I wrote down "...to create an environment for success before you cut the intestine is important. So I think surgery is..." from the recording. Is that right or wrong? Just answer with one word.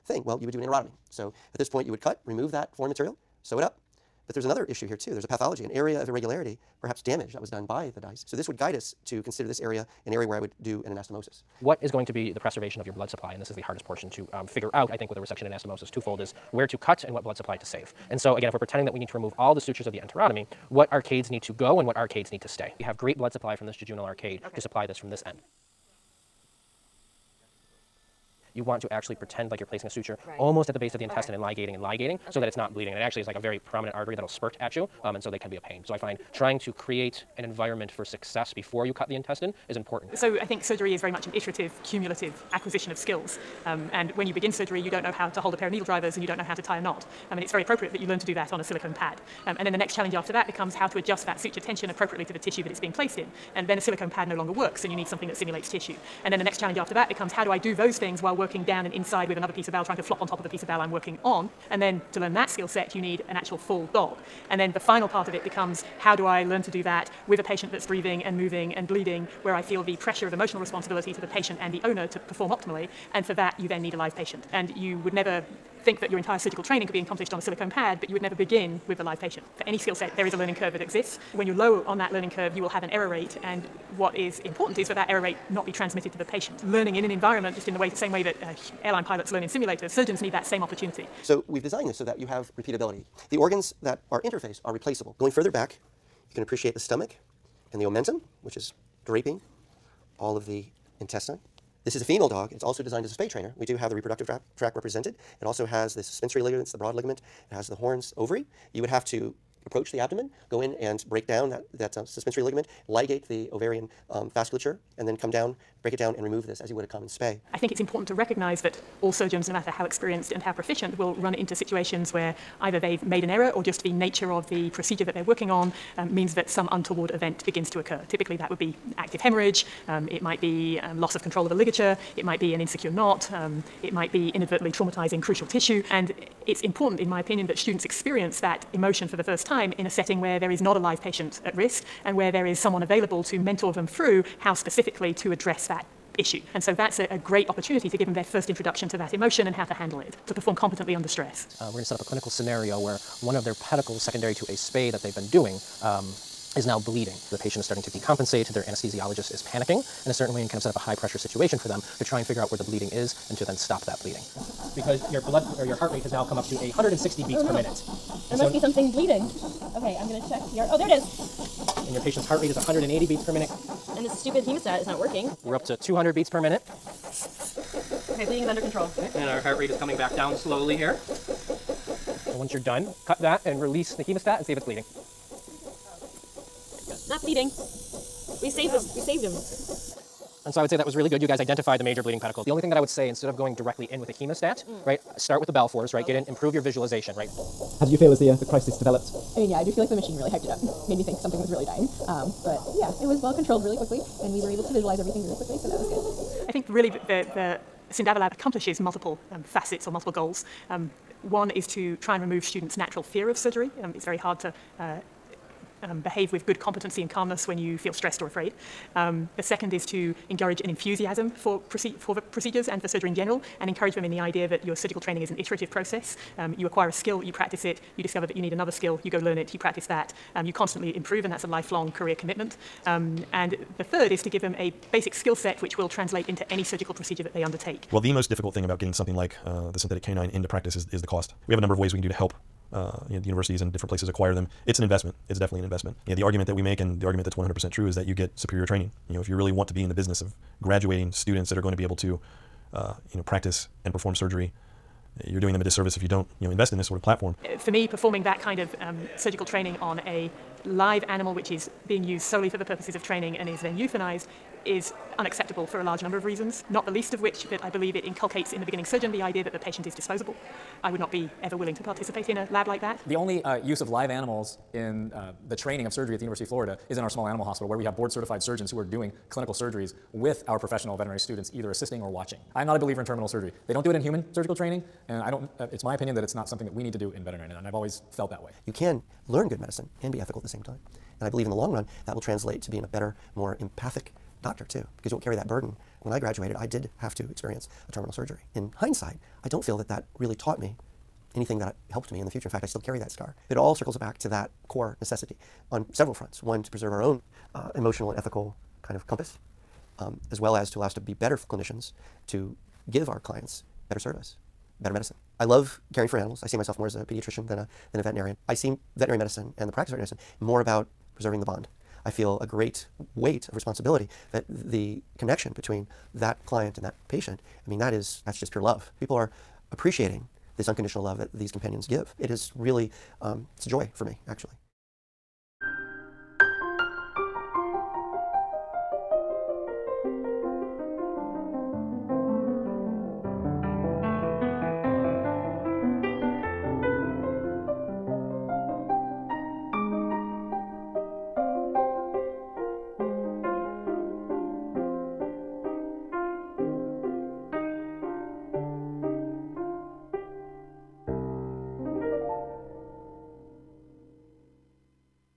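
right.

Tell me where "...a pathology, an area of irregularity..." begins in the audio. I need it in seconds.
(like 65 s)
5 s.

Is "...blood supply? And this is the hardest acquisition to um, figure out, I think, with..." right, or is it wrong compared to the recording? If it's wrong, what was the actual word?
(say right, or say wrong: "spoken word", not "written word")
wrong: "portion", not "acquisition".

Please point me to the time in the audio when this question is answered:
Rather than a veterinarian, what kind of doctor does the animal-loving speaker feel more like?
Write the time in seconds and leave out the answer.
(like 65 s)
317 s.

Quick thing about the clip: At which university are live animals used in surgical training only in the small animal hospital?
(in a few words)
University of Florida.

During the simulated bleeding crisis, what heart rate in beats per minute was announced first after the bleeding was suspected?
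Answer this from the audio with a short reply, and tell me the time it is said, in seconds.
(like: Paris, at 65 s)
160, at 166 s.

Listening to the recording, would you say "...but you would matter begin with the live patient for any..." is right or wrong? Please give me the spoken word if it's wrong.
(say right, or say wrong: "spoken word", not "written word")
wrong: "never", not "matter".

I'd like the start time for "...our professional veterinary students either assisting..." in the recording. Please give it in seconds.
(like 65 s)
280 s.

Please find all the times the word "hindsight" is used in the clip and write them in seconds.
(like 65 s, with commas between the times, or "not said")
298 s.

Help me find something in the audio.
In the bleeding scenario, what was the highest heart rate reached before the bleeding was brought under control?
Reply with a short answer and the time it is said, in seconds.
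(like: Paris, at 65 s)
200, at 175 s.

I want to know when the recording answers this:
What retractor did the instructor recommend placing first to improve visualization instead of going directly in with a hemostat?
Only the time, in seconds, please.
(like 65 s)
195 s.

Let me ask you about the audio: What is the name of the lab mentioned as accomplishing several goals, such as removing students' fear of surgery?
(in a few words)
SynDaver Lab.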